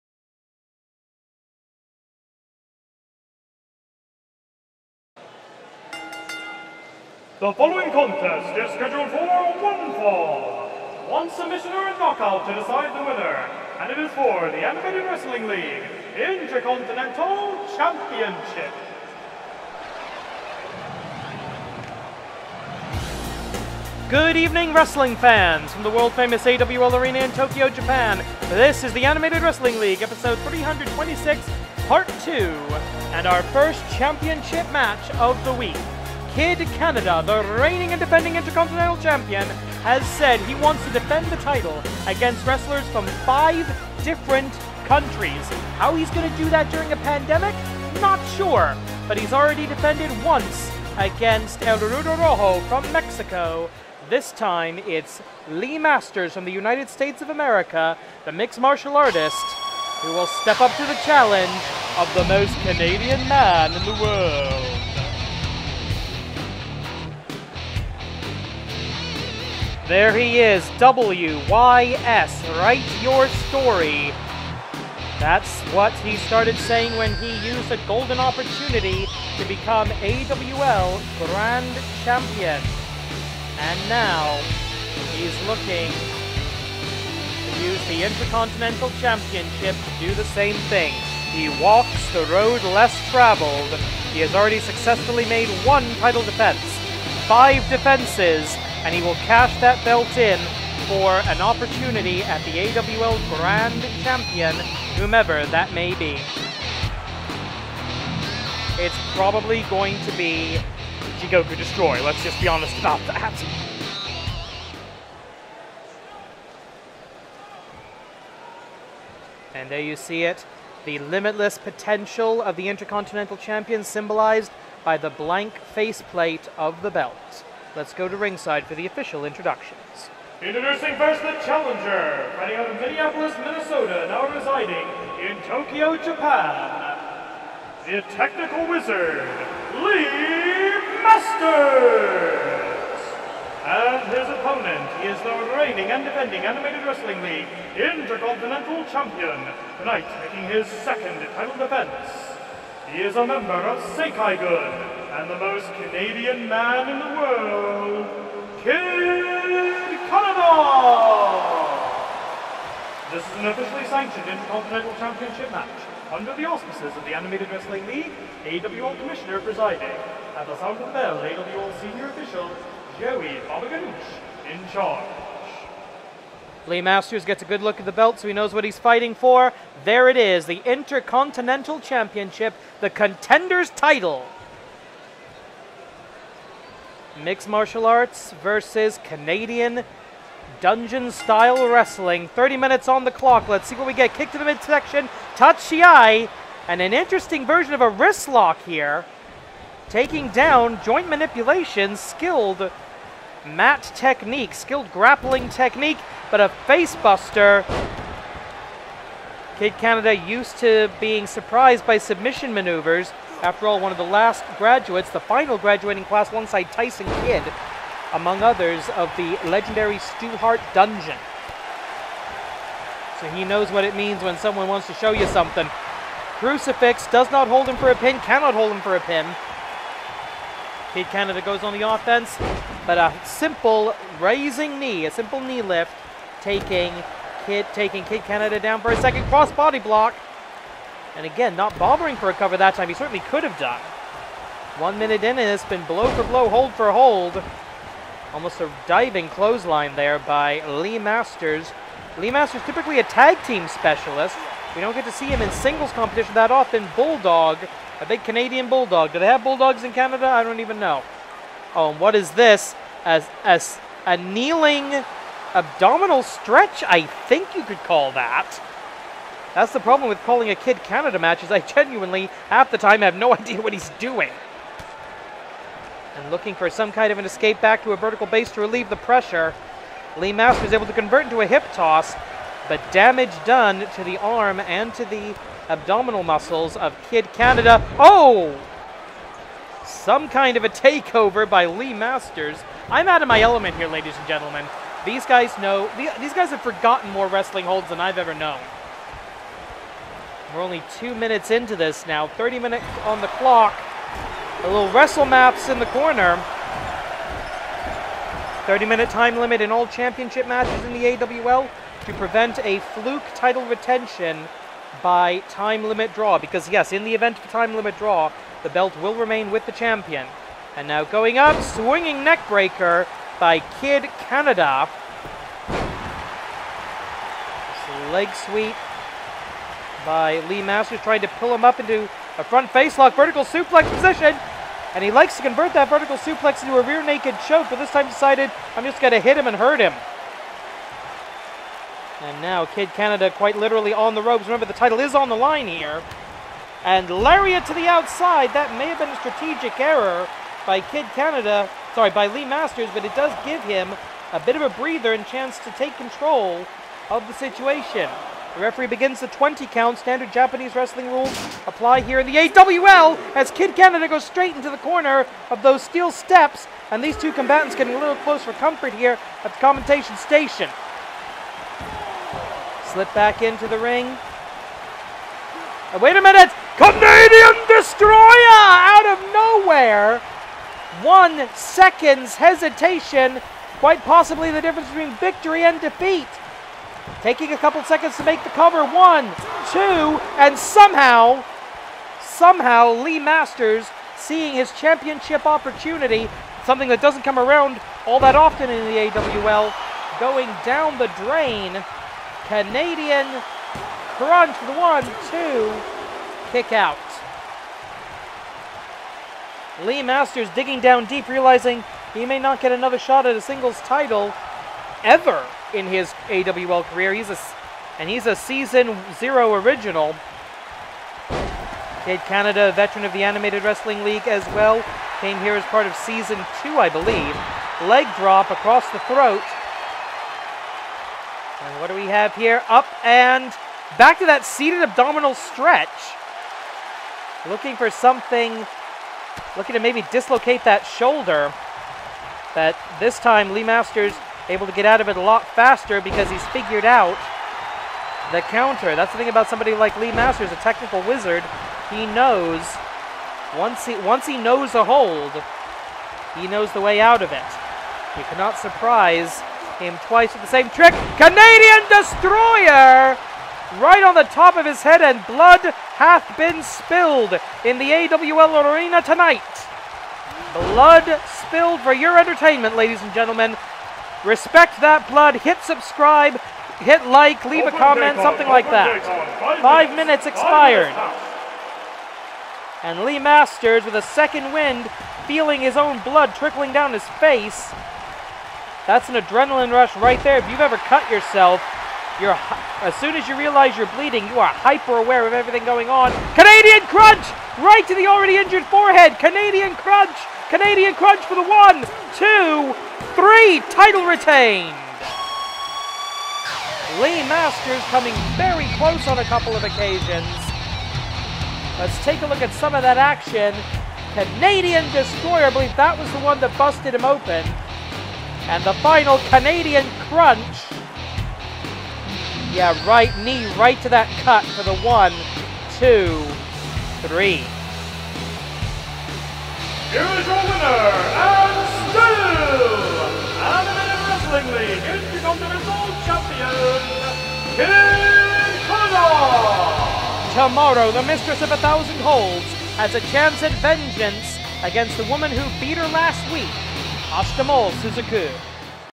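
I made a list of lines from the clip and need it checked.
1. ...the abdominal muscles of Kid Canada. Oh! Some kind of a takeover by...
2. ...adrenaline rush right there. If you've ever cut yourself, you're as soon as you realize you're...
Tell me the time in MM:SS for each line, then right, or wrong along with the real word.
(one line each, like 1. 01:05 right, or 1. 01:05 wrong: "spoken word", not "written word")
1. 04:45 right
2. 08:09 right.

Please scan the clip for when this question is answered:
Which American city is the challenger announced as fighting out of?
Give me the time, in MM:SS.
02:12.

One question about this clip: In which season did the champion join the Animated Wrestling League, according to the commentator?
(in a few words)
Season 2.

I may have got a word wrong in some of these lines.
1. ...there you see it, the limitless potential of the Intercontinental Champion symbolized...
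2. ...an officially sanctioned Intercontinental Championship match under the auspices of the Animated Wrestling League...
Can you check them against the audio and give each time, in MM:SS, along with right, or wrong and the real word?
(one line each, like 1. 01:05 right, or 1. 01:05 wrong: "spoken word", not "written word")
1. 01:59 right
2. 02:43 right.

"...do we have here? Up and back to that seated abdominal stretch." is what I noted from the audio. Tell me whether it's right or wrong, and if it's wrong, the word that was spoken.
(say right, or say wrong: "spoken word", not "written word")
right.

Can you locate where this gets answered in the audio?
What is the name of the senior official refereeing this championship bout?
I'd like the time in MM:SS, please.
02:52.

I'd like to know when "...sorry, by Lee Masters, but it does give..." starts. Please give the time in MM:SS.
05:51.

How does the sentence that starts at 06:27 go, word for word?
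Taking a couple seconds to make the cover.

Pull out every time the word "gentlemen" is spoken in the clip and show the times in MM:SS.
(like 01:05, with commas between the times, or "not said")
04:54, 07:53.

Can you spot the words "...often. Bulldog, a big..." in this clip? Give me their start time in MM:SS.
04:16.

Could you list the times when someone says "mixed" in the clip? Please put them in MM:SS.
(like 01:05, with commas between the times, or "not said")
00:58, 03:07.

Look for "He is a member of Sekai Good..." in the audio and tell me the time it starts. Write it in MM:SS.
02:32.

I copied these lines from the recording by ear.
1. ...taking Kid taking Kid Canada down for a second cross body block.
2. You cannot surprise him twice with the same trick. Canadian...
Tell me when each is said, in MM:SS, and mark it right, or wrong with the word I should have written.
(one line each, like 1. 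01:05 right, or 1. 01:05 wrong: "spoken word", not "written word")
1. 03:56 right
2. 07:38 right.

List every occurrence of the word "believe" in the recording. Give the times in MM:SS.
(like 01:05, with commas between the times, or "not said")
07:06, 08:35.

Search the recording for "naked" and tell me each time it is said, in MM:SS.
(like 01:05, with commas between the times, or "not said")
05:37.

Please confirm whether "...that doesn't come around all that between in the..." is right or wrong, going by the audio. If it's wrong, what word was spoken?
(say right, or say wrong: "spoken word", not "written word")
wrong: "often", not "between".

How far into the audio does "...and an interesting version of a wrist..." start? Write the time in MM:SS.
03:16.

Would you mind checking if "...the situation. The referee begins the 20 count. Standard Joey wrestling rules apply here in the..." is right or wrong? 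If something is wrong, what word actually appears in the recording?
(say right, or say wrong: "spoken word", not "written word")
wrong: "Japanese", not "Joey".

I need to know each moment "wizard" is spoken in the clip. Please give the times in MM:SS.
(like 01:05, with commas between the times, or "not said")
02:18, 07:31.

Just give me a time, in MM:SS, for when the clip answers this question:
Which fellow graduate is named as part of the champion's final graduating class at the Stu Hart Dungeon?
03:36.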